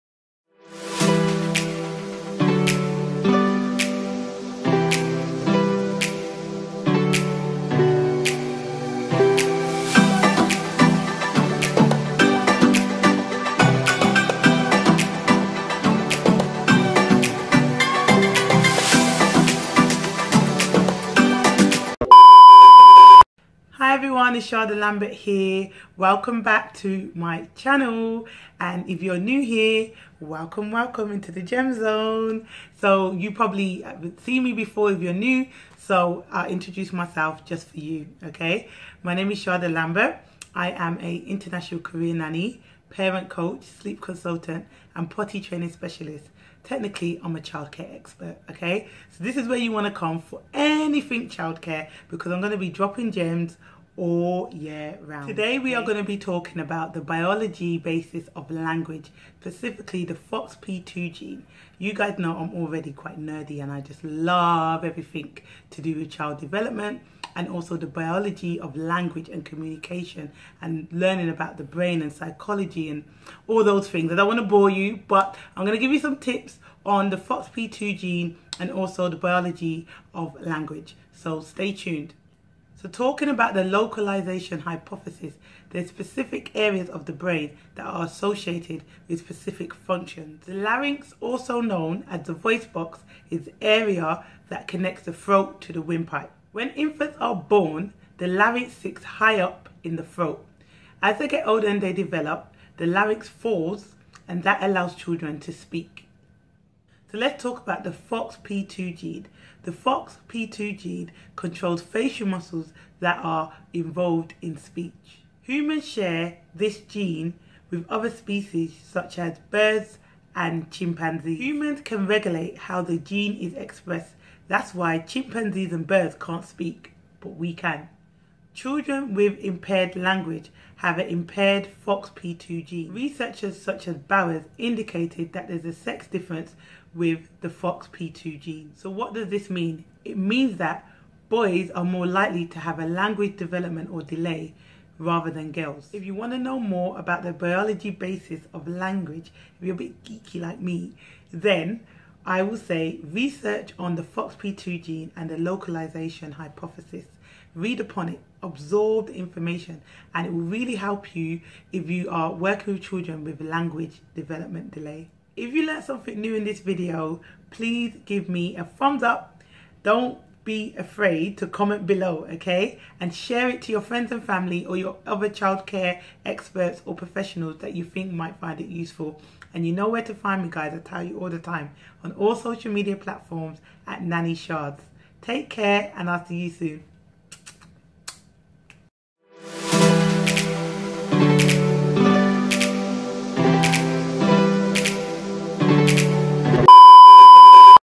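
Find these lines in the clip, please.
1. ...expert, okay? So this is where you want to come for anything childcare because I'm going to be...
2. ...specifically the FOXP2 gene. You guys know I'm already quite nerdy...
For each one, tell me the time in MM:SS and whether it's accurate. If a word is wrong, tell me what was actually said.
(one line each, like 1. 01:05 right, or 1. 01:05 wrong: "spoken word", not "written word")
1. 00:47 right
2. 00:59 right.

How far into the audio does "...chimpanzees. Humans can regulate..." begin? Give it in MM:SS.
02:00.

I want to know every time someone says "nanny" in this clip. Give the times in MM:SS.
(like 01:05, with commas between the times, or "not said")
00:42, 03:04.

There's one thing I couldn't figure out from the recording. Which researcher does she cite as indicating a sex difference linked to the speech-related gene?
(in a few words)
Bowers.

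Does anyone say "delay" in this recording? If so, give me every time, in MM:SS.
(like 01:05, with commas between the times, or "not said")
02:24, 02:44.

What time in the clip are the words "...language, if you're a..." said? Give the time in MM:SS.
02:28.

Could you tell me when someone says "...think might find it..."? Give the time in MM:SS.
02:57.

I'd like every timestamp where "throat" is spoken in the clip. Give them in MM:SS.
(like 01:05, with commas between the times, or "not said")
01:35, 01:40.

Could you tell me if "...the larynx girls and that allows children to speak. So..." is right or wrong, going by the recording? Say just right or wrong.
wrong.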